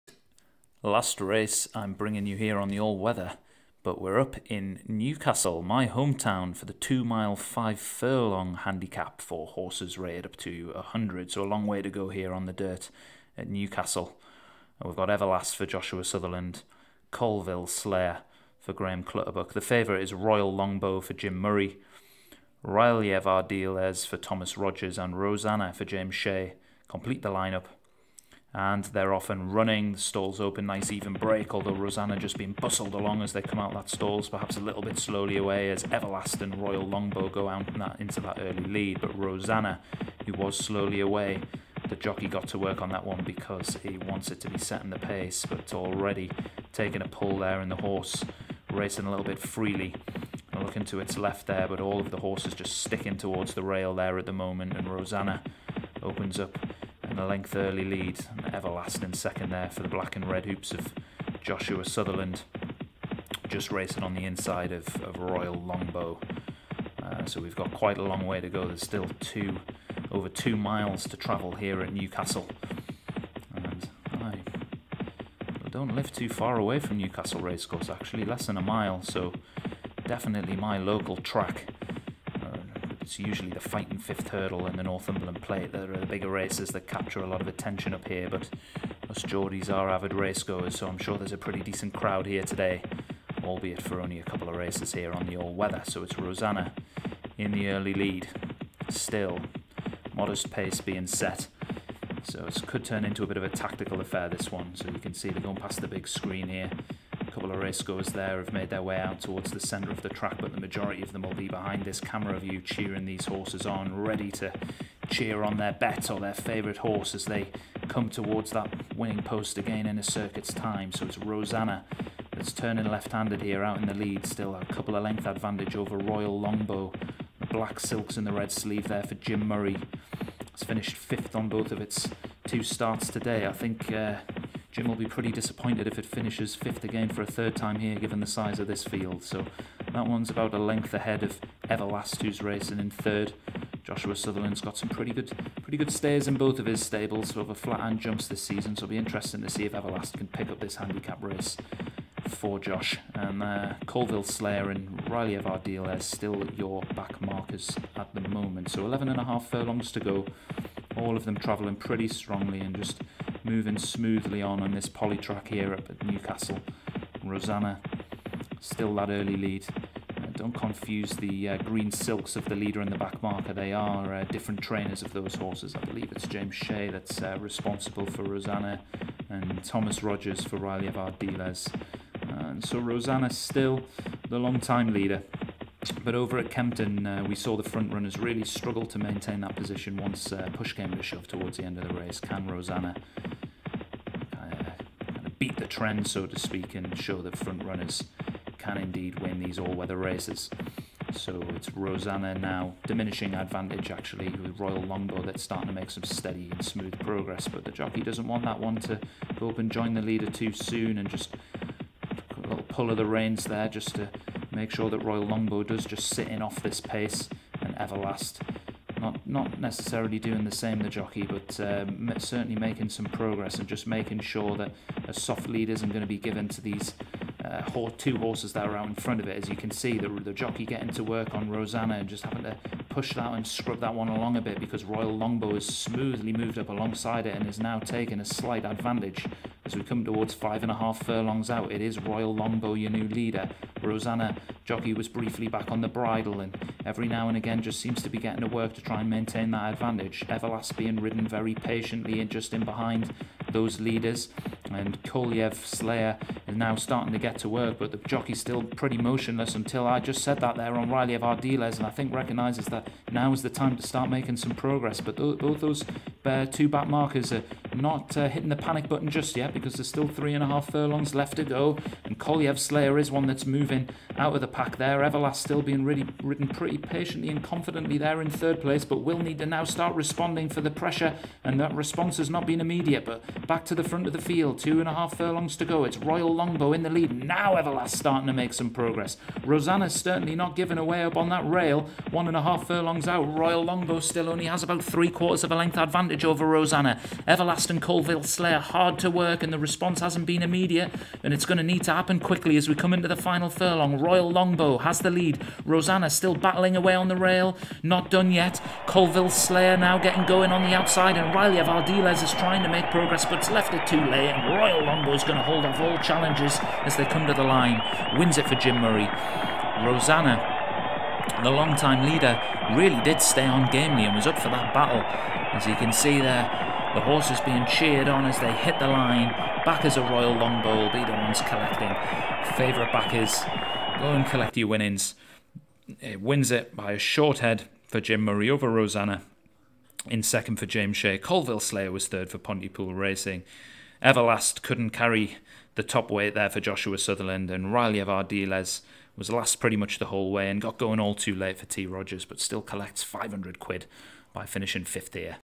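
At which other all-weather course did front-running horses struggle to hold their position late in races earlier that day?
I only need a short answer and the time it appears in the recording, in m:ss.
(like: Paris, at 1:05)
Kempton, at 3:06.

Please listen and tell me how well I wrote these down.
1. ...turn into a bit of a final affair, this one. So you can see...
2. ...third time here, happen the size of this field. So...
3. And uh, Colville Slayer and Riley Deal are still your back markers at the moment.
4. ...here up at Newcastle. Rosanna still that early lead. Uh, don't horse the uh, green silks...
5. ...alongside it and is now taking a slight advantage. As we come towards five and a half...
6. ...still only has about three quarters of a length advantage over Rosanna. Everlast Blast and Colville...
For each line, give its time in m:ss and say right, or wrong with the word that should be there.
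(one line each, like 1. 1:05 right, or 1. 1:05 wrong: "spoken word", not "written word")
1. 1:42 wrong: "tactical", not "final"
2. 2:17 wrong: "given", not "happen"
3. 2:33 right
4. 2:45 wrong: "confuse", not "horse"
5. 3:56 right
6. 4:53 right.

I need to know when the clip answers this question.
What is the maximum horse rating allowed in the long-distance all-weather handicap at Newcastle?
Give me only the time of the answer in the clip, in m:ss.
0:10.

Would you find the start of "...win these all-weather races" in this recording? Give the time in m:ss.
3:19.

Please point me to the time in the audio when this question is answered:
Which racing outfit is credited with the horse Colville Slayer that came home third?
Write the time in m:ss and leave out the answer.
5:42.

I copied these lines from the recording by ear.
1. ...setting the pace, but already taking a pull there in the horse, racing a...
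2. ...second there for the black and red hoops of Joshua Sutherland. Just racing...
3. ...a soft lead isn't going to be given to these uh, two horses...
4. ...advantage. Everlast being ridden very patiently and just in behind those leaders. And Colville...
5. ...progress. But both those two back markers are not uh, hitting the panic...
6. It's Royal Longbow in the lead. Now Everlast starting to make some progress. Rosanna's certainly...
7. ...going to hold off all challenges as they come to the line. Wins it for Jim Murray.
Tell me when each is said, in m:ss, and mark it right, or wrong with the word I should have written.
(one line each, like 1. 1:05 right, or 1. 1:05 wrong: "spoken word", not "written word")
1. 0:44 right
2. 0:59 right
3. 3:45 right
4. 4:09 right
5. 4:24 right
6. 4:45 right
7. 5:15 right.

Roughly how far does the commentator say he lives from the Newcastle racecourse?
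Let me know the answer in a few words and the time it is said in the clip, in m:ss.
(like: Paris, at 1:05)
Less than a mile, at 1:18.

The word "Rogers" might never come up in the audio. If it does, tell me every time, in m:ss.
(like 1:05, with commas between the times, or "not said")
0:24, 3:00, 5:51.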